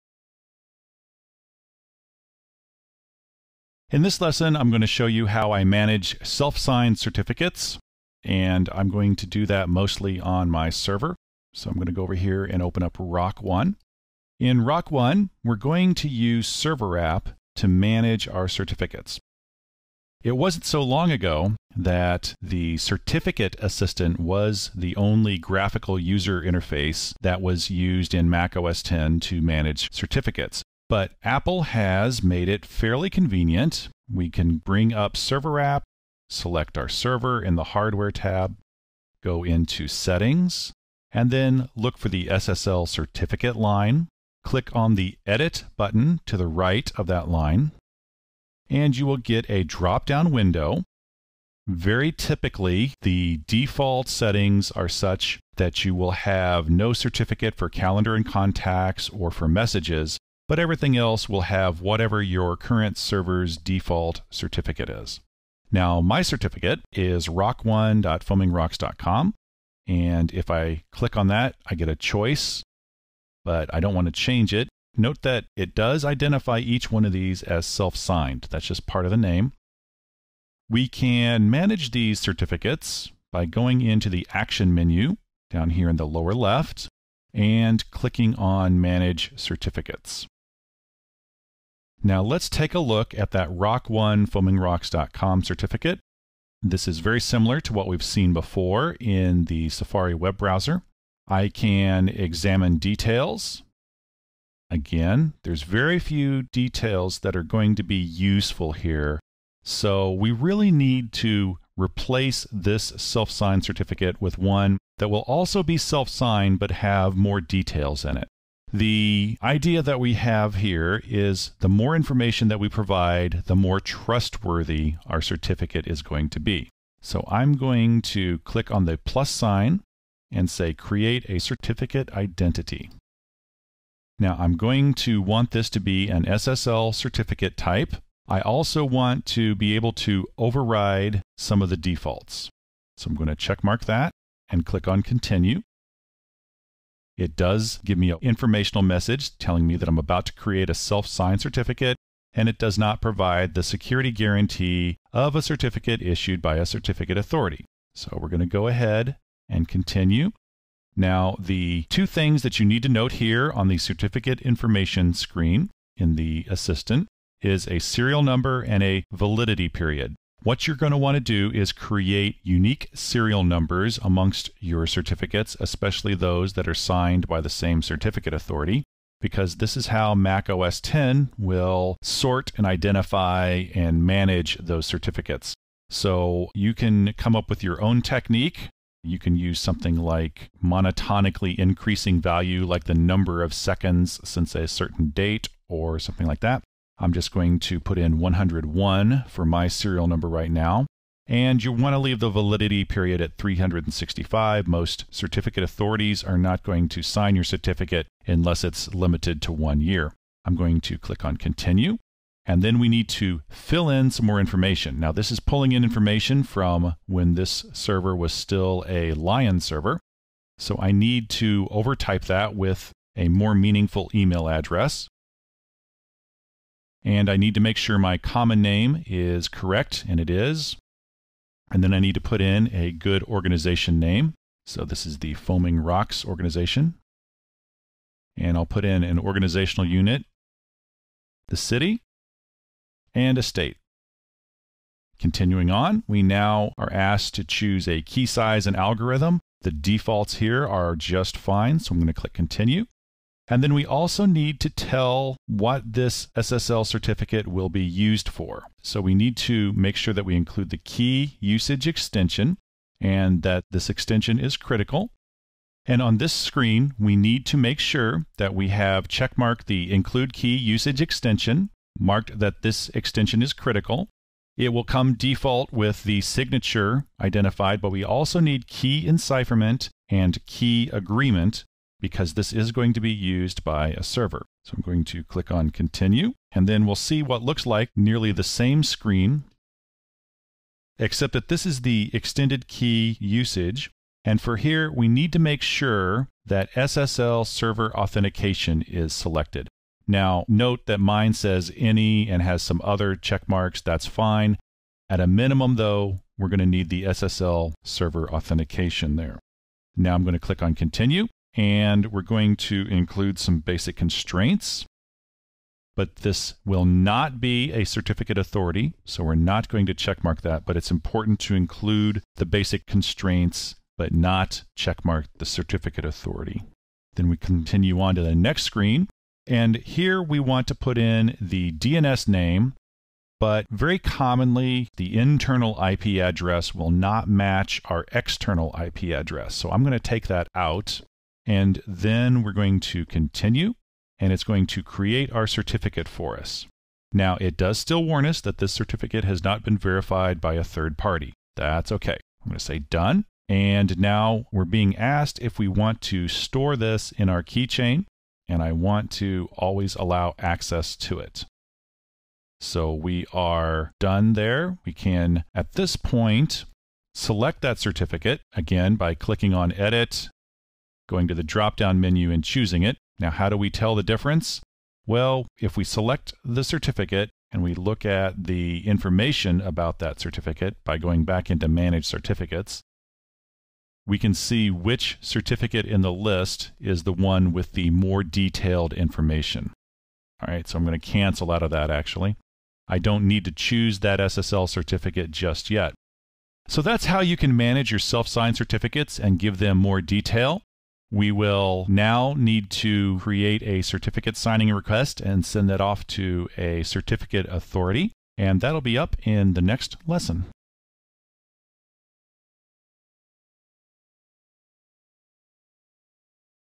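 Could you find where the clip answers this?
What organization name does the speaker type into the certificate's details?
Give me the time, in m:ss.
3:55.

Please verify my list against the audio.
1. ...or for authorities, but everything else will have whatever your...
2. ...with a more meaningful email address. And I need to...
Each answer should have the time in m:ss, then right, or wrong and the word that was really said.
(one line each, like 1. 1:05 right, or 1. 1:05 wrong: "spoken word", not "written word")
1. 0:59 wrong: "messages", not "authorities"
2. 3:42 right.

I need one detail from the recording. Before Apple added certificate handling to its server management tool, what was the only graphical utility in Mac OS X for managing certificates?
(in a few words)
Certificate Assistant.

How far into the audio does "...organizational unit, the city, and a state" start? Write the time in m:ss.
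3:59.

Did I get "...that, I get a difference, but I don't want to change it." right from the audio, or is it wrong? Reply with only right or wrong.
wrong.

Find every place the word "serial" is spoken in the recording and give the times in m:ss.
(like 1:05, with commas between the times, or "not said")
2:47, 2:52, 3:19.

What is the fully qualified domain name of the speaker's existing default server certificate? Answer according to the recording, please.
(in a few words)
rock1.foamingrocks.com.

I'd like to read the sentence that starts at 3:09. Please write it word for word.
You can use something like monotonically increasing value, like the number of seconds since a certain date or something like that.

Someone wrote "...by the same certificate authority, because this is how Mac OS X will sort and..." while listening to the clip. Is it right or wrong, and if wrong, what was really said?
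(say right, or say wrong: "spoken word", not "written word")
right.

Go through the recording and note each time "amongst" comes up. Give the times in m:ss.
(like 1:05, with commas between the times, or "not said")
2:54.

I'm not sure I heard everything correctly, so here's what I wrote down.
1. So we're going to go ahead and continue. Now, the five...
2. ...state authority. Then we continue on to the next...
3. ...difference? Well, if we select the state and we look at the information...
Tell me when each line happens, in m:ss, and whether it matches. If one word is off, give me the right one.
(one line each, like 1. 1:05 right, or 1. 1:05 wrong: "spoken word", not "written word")
1. 2:37 wrong: "two", not "five"
2. 5:25 wrong: "certificate", not "state"
3. 6:14 wrong: "certificate", not "state".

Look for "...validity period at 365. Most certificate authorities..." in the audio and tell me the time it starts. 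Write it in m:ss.
3:22.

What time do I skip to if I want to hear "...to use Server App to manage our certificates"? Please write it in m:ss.
0:15.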